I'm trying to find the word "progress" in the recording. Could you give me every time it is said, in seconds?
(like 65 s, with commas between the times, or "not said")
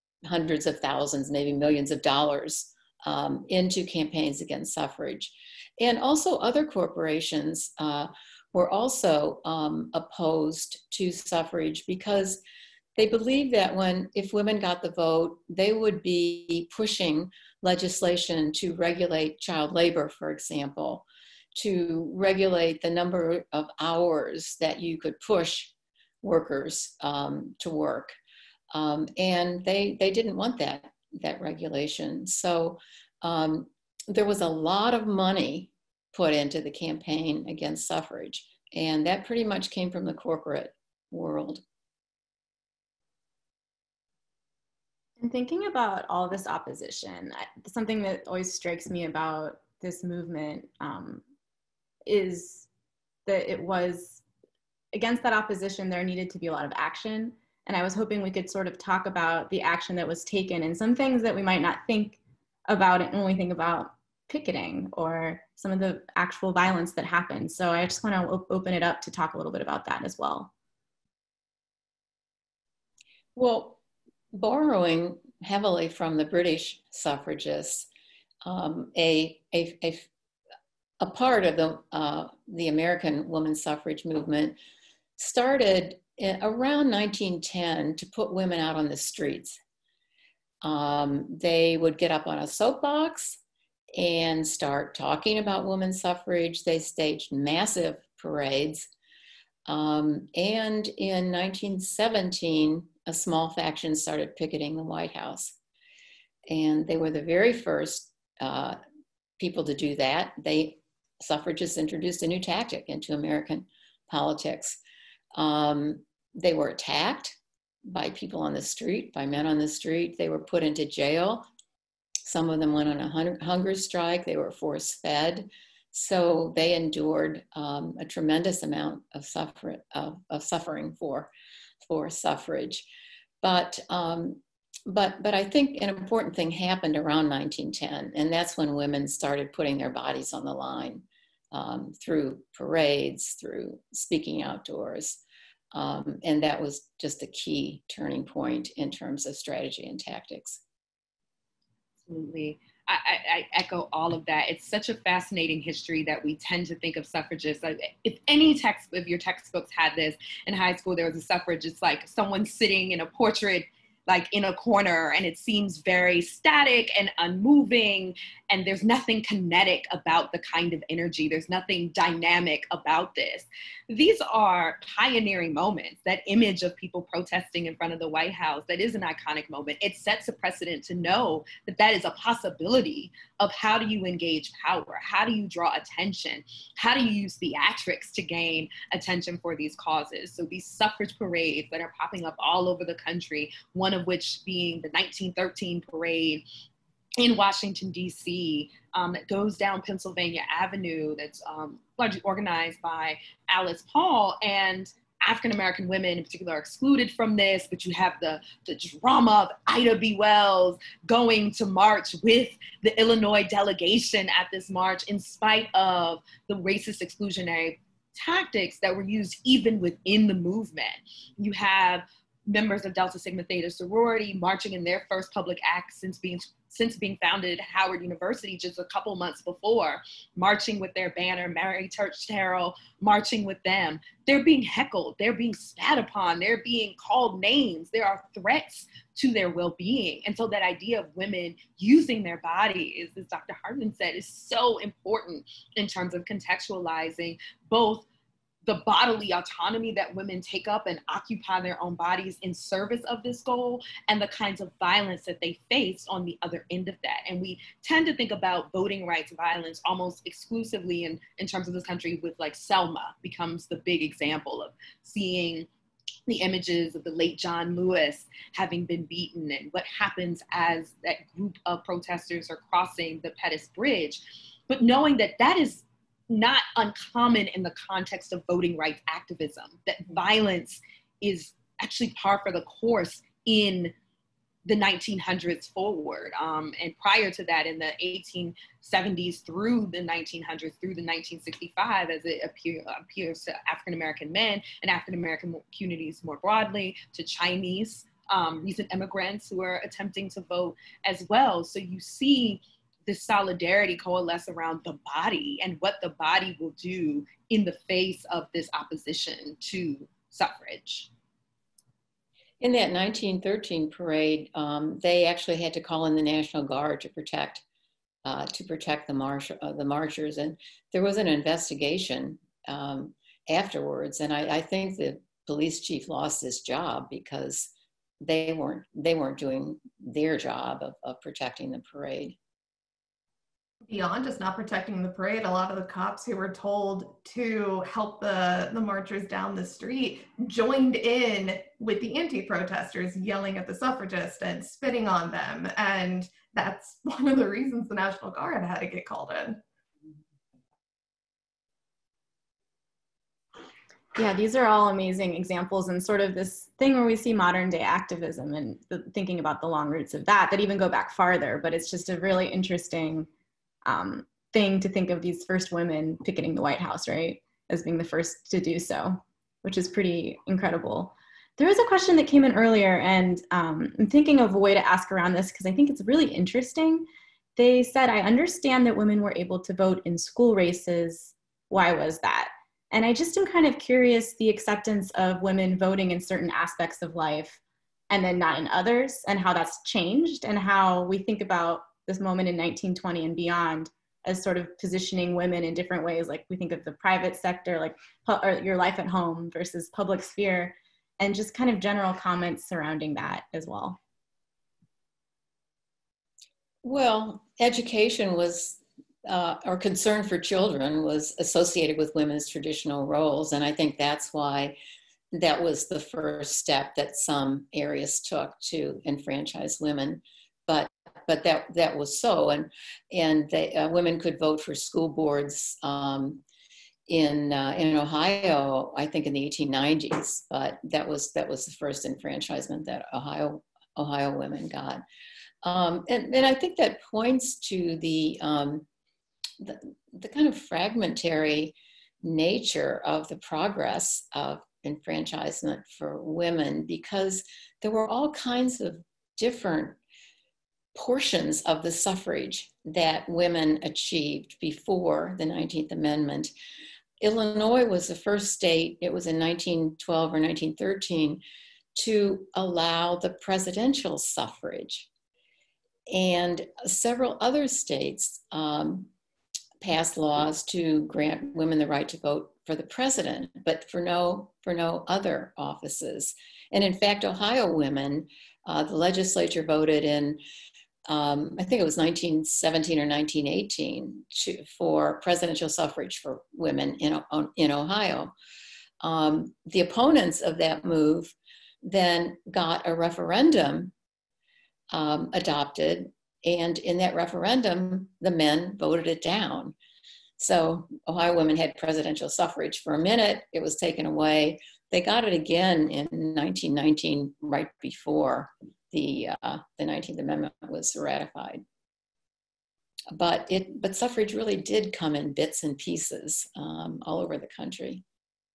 443 s.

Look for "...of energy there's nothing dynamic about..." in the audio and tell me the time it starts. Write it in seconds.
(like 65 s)
170 s.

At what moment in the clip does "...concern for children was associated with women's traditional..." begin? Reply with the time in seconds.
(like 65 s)
409 s.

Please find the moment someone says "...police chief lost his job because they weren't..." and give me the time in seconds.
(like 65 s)
325 s.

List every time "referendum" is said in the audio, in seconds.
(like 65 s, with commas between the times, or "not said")
492 s, 497 s.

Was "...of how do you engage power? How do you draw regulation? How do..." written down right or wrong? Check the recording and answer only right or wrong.
wrong.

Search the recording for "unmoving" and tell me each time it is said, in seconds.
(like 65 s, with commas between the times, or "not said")
167 s.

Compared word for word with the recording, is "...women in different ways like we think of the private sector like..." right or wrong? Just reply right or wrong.
right.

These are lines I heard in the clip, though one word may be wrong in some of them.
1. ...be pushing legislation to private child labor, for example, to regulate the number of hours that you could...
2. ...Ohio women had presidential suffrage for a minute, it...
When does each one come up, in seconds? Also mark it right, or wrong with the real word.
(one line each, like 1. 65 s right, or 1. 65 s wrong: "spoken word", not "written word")
1. 16 s wrong: "regulate", not "private"
2. 501 s right.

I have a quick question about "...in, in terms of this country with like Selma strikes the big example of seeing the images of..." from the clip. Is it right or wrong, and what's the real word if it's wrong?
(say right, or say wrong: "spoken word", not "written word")
wrong: "becomes", not "strikes".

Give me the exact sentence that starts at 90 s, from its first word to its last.
Um, they would get up on a soapbox and start talking about women's suffrage.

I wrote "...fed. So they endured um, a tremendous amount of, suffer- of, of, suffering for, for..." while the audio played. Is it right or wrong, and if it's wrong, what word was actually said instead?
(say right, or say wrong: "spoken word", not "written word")
right.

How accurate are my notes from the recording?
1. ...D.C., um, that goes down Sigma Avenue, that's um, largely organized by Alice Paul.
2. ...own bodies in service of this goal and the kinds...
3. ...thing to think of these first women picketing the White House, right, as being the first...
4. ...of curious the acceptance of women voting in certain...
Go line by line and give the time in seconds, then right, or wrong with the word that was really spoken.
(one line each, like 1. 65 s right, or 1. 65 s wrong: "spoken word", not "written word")
1. 197 s wrong: "Pennsylvania", not "Sigma"
2. 251 s right
3. 364 s right
4. 383 s right.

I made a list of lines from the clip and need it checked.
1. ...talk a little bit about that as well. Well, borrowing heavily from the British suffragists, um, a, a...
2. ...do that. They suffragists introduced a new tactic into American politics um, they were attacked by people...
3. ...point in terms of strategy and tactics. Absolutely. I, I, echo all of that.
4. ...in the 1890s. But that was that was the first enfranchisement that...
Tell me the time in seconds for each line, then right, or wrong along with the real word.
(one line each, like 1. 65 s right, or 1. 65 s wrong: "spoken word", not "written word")
1. 69 s right
2. 109 s right
3. 148 s right
4. 429 s right.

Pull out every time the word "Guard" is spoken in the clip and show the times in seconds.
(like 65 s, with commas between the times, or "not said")
316 s, 348 s.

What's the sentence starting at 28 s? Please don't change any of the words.
Um, and they, they didn't want that, that regulation.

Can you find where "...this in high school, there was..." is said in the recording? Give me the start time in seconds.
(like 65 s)
159 s.